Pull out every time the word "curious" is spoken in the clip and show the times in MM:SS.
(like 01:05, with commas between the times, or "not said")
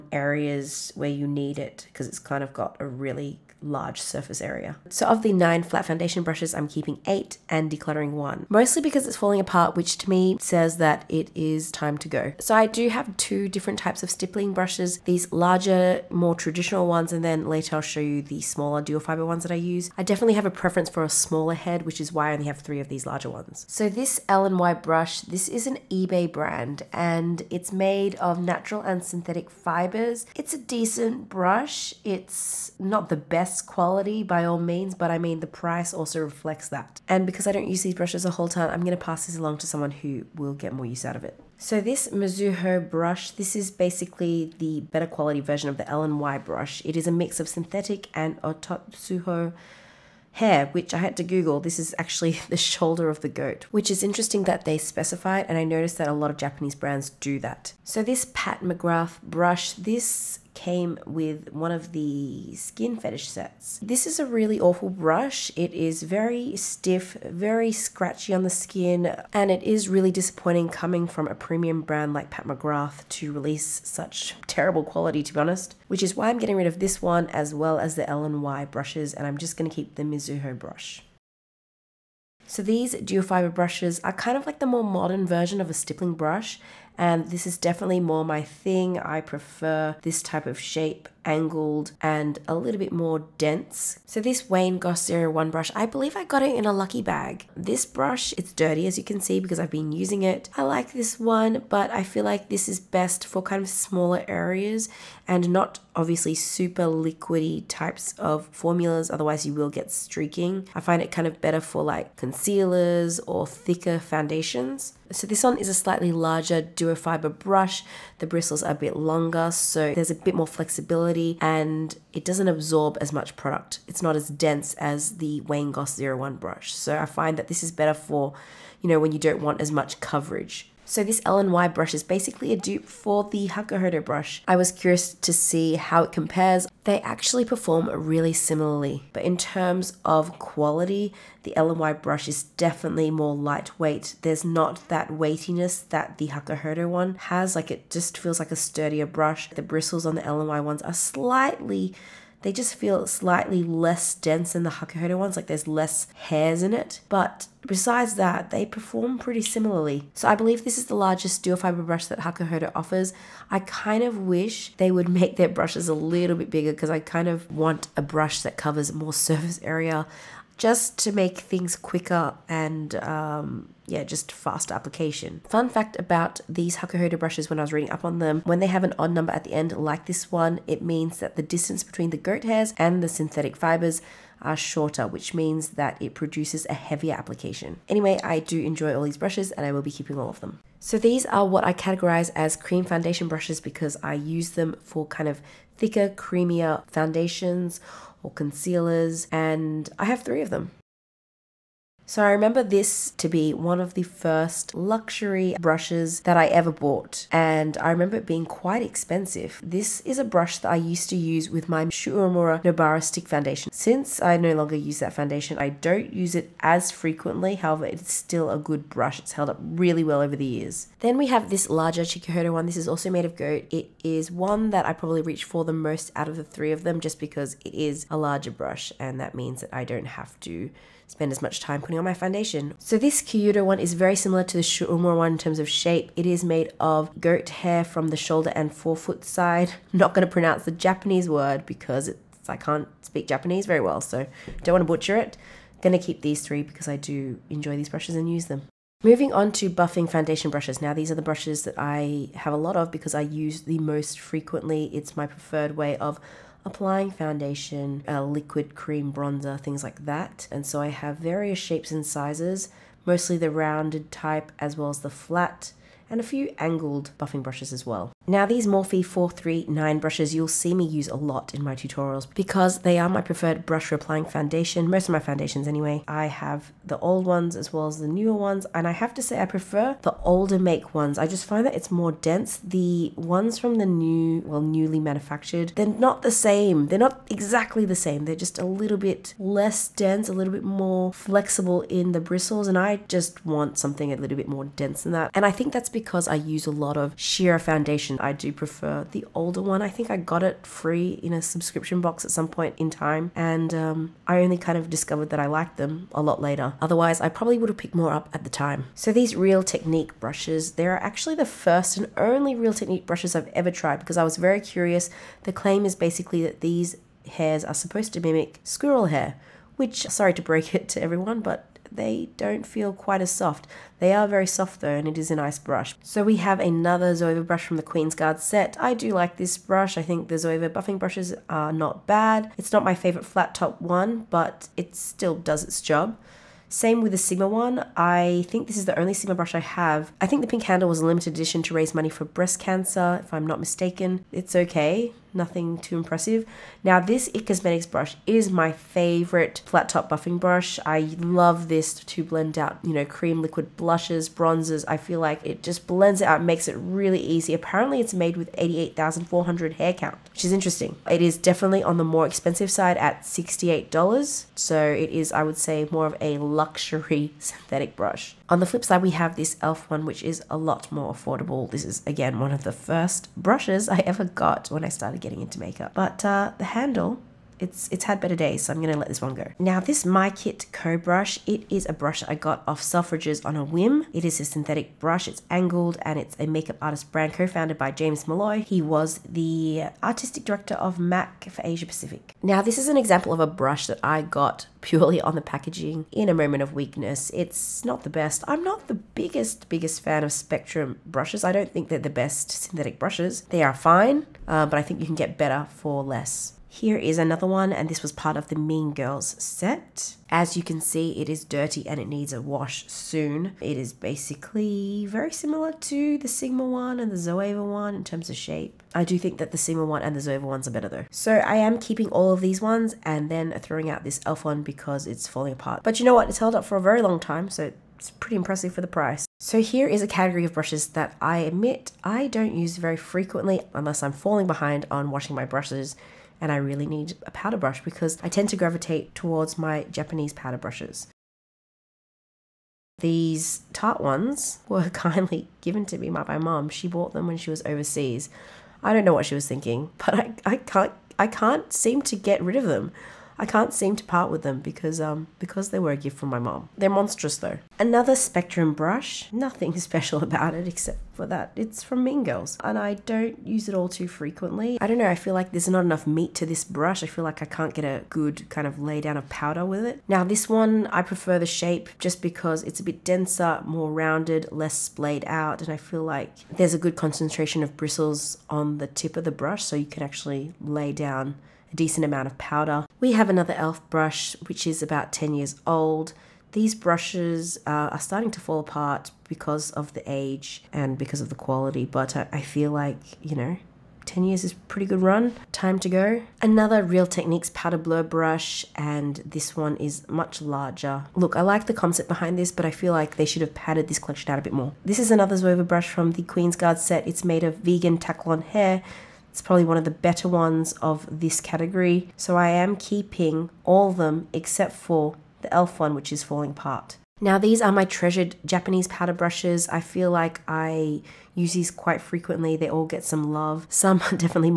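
02:14, 05:14.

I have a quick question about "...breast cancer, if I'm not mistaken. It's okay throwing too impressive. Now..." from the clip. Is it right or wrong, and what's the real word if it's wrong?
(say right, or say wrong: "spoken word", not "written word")
wrong: "nothing", not "throwing".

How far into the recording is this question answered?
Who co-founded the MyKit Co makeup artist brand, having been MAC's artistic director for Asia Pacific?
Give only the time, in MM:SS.
06:27.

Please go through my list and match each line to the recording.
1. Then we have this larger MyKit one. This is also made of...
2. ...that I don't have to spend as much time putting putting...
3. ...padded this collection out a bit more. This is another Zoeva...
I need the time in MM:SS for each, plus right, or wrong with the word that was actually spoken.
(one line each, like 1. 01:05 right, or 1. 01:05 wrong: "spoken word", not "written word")
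1. 03:40 wrong: "Chikuhodo", not "MyKit"
2. 03:49 right
3. 08:23 right.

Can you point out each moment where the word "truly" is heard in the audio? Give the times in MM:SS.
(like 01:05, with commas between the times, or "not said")
not said.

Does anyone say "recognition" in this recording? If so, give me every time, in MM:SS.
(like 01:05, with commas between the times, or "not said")
not said.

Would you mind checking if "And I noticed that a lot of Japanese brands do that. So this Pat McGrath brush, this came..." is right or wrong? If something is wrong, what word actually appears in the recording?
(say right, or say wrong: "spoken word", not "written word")
right.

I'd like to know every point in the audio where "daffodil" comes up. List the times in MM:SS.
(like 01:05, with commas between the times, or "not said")
not said.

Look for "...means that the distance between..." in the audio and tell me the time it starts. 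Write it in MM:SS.
03:00.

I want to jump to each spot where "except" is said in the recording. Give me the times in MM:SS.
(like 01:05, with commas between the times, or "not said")
07:40, 08:34.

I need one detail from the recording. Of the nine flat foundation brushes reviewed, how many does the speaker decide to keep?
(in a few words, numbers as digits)
8.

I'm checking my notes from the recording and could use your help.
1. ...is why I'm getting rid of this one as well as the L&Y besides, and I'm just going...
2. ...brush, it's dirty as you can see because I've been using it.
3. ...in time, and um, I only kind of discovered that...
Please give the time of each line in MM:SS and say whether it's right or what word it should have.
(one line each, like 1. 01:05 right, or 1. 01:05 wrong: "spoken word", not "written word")
1. 01:16 wrong: "brushes", not "besides"
2. 01:37 right
3. 05:02 right.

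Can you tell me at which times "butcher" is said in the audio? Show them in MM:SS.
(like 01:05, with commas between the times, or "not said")
04:04.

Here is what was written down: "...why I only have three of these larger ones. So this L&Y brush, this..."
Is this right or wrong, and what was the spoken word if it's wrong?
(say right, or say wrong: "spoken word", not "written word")
right.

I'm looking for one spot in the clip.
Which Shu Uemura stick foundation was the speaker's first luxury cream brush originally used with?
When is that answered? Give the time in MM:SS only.
03:32.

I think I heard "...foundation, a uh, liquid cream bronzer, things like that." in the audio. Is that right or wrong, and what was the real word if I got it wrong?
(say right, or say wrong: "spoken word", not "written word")
right.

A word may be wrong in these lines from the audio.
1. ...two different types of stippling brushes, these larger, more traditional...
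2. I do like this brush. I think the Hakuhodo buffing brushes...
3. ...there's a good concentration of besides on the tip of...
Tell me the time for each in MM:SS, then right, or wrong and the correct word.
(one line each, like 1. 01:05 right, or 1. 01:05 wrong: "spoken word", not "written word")
1. 00:13 right
2. 05:28 wrong: "Zoeva", not "Hakuhodo"
3. 07:56 wrong: "bristles", not "besides".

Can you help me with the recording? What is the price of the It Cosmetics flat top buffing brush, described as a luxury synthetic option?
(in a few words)
$68.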